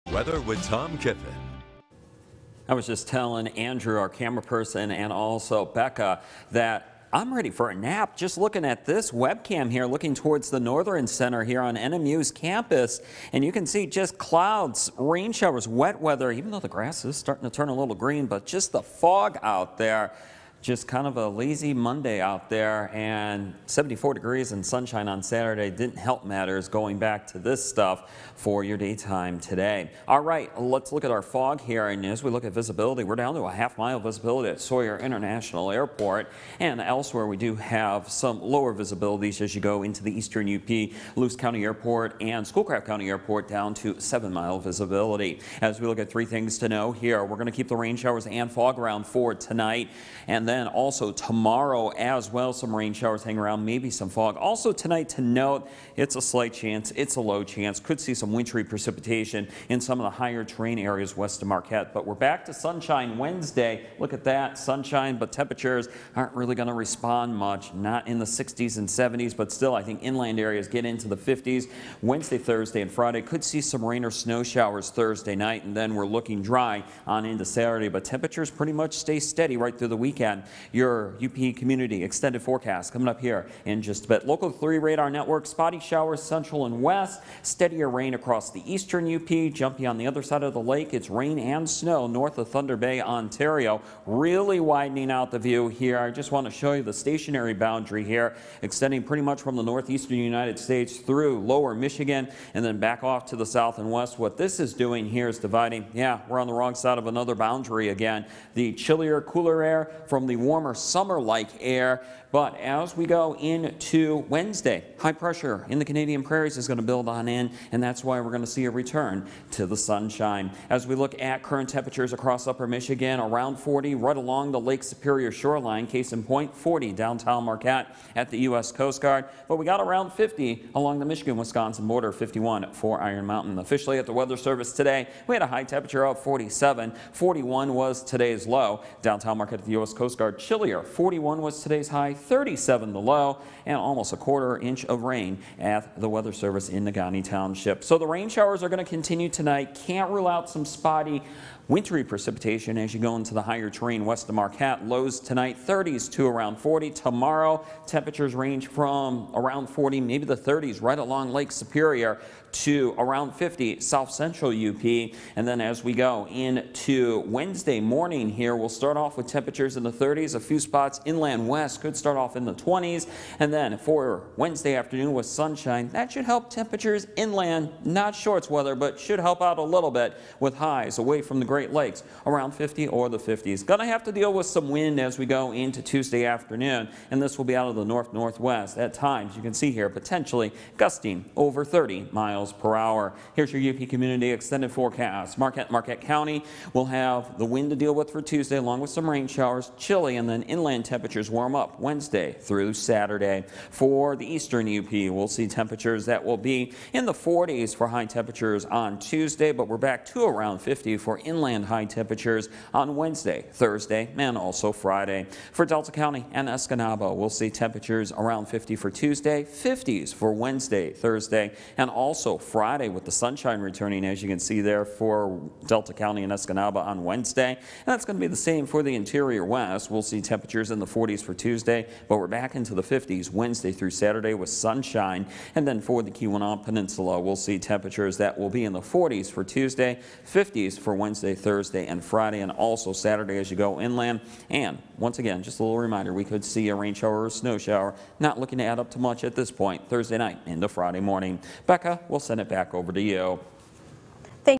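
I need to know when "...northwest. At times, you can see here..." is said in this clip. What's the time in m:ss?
3:08.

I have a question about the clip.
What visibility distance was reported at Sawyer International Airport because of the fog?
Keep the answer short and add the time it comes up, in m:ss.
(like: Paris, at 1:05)
half mile, at 0:33.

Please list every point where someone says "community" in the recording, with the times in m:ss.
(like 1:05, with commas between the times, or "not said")
1:21, 3:13.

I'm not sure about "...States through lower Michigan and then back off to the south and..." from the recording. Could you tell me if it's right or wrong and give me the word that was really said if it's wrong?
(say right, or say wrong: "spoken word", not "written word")
right.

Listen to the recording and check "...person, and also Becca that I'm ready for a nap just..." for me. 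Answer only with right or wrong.
right.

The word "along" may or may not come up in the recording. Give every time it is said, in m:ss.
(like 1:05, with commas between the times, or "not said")
2:04, 2:10, 2:40, 3:18.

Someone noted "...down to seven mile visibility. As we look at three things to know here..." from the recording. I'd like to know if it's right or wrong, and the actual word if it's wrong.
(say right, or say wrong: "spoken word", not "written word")
right.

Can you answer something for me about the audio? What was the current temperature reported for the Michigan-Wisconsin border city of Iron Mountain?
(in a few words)
51.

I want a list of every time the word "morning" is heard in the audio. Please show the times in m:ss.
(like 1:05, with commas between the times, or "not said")
2:47, 4:11.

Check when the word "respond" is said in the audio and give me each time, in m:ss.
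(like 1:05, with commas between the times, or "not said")
1:06.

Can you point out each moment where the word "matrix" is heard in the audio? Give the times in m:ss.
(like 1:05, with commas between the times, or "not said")
not said.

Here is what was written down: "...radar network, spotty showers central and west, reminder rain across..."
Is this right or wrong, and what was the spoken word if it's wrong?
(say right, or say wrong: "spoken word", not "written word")
wrong: "steadier", not "reminder".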